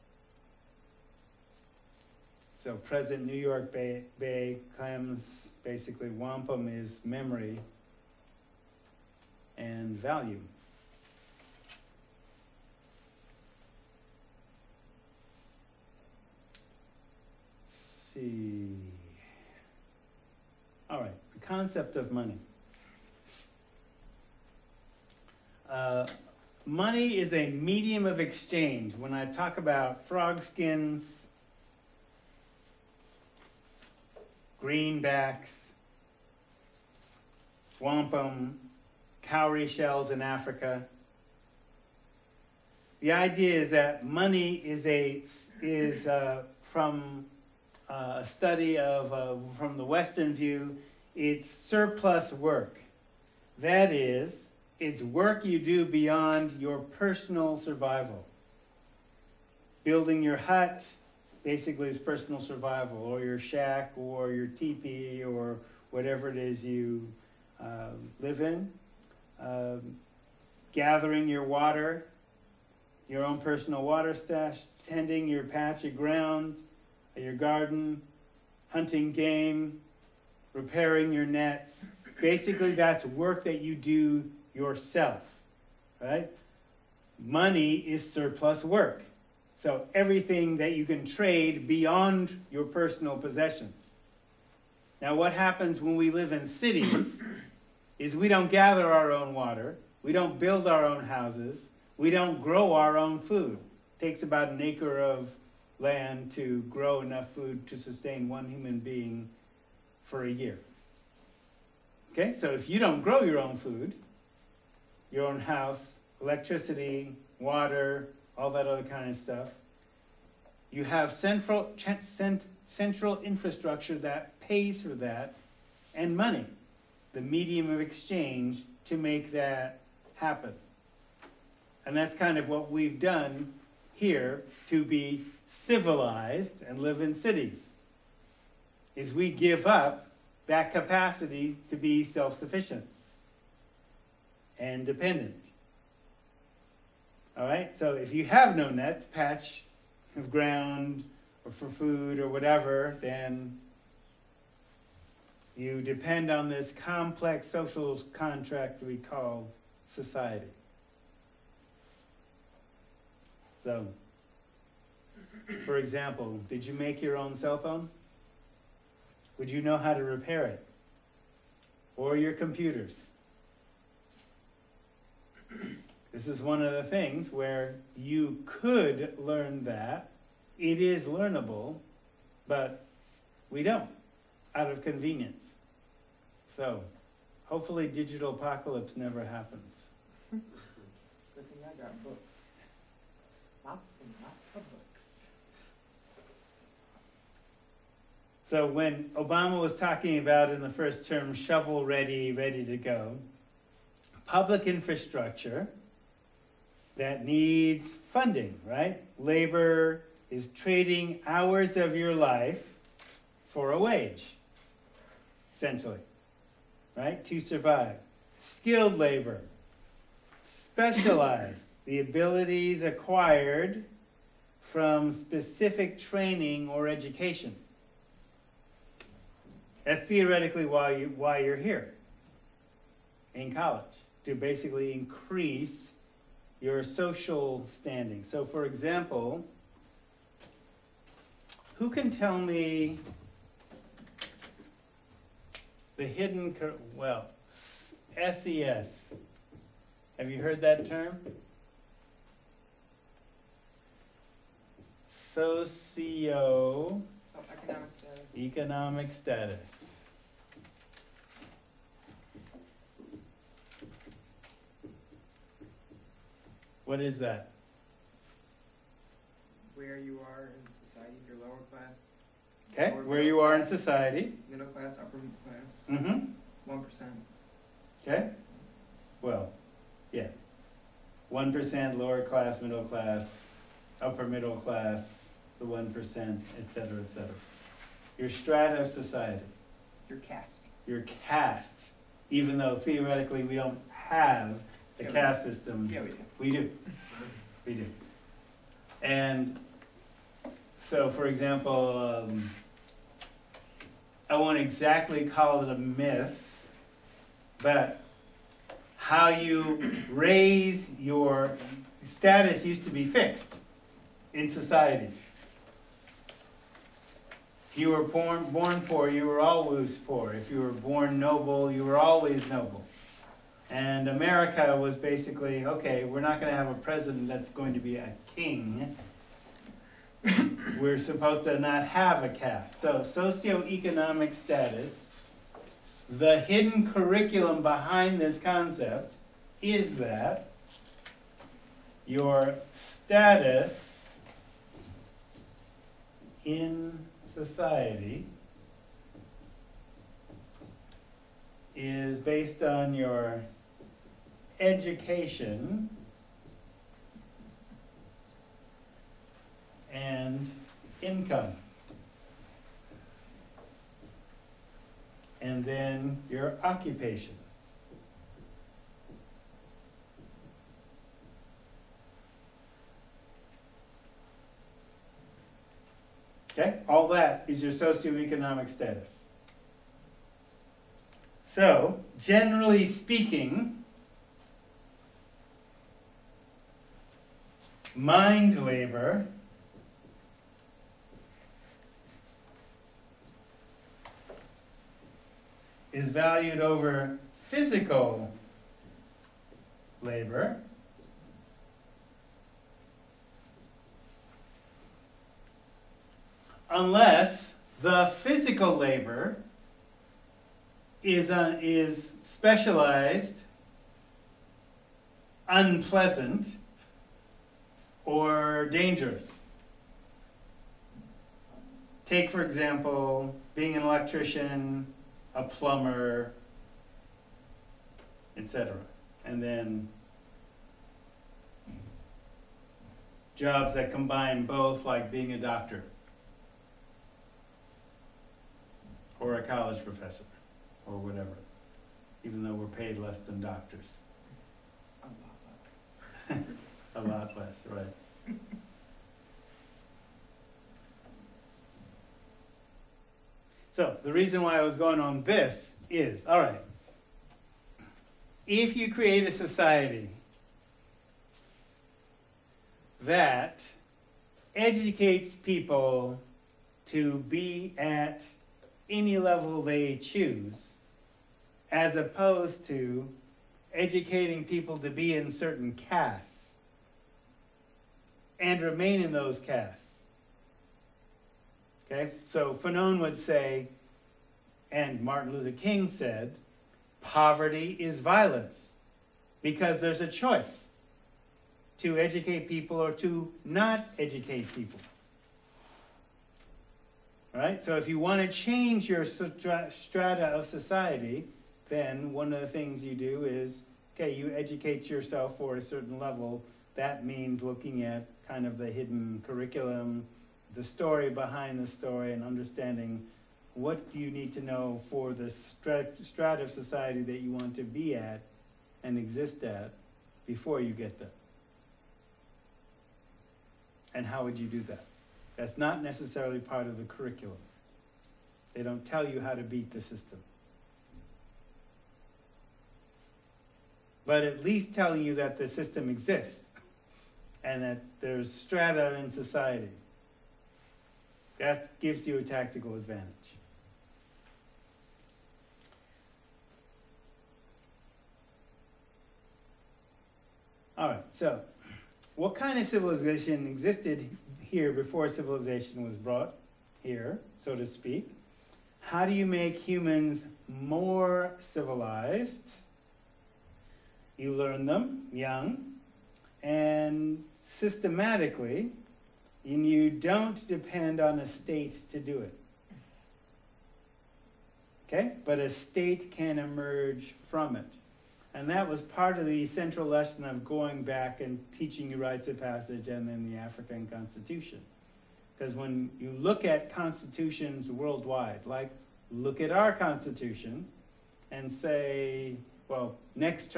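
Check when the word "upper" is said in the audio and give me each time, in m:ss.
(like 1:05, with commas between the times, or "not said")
4:34, 4:44.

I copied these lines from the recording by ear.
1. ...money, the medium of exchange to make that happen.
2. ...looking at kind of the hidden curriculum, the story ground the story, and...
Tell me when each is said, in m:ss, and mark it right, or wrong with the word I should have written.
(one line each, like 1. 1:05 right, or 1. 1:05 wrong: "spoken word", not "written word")
1. 2:06 right
2. 8:27 wrong: "behind", not "ground".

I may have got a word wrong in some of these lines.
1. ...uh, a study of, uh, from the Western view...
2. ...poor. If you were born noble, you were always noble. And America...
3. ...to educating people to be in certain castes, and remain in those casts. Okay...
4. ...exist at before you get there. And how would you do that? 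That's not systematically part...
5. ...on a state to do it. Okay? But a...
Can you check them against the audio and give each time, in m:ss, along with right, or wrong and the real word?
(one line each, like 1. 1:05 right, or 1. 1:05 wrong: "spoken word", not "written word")
1. 0:47 right
2. 5:19 right
3. 7:52 right
4. 8:38 wrong: "necessarily", not "systematically"
5. 9:31 right.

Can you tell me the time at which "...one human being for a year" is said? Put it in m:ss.
1:48.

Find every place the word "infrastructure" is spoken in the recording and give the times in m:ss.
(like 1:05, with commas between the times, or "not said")
2:03, 3:24.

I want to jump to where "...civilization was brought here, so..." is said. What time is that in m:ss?
9:15.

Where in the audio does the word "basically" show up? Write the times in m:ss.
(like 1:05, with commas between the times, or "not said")
0:05, 1:01, 1:22, 3:54, 5:24.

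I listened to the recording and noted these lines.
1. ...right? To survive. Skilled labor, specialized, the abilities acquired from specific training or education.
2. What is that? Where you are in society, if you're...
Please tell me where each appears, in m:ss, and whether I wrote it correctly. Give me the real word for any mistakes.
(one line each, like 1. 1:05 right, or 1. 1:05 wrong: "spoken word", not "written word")
1. 3:36 right
2. 4:26 right.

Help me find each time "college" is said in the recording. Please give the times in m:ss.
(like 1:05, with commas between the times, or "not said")
3:53, 7:19.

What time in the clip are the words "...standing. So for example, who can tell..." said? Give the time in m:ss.
3:57.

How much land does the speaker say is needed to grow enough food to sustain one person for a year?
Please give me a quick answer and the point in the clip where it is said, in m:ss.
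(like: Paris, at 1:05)
an acre, at 1:44.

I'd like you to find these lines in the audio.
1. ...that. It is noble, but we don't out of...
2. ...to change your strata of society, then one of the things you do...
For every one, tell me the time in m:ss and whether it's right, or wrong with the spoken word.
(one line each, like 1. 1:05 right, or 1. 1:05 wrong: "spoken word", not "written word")
1. 2:59 wrong: "learnable", not "noble"
2. 8:18 right.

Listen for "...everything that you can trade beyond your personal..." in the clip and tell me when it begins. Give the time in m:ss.
1:29.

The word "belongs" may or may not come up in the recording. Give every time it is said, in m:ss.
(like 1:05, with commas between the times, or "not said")
not said.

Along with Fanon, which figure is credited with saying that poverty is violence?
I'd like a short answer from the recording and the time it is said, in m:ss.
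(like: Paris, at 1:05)
Martin Luther King, at 8:05.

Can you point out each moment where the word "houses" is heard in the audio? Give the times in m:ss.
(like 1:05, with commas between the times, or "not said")
1:41, 1:55.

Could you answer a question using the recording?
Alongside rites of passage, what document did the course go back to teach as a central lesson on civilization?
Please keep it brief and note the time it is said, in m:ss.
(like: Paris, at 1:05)
the African Constitution, at 9:43.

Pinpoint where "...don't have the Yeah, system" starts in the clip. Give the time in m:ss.
4:53.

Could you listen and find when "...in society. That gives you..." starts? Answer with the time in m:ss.
8:58.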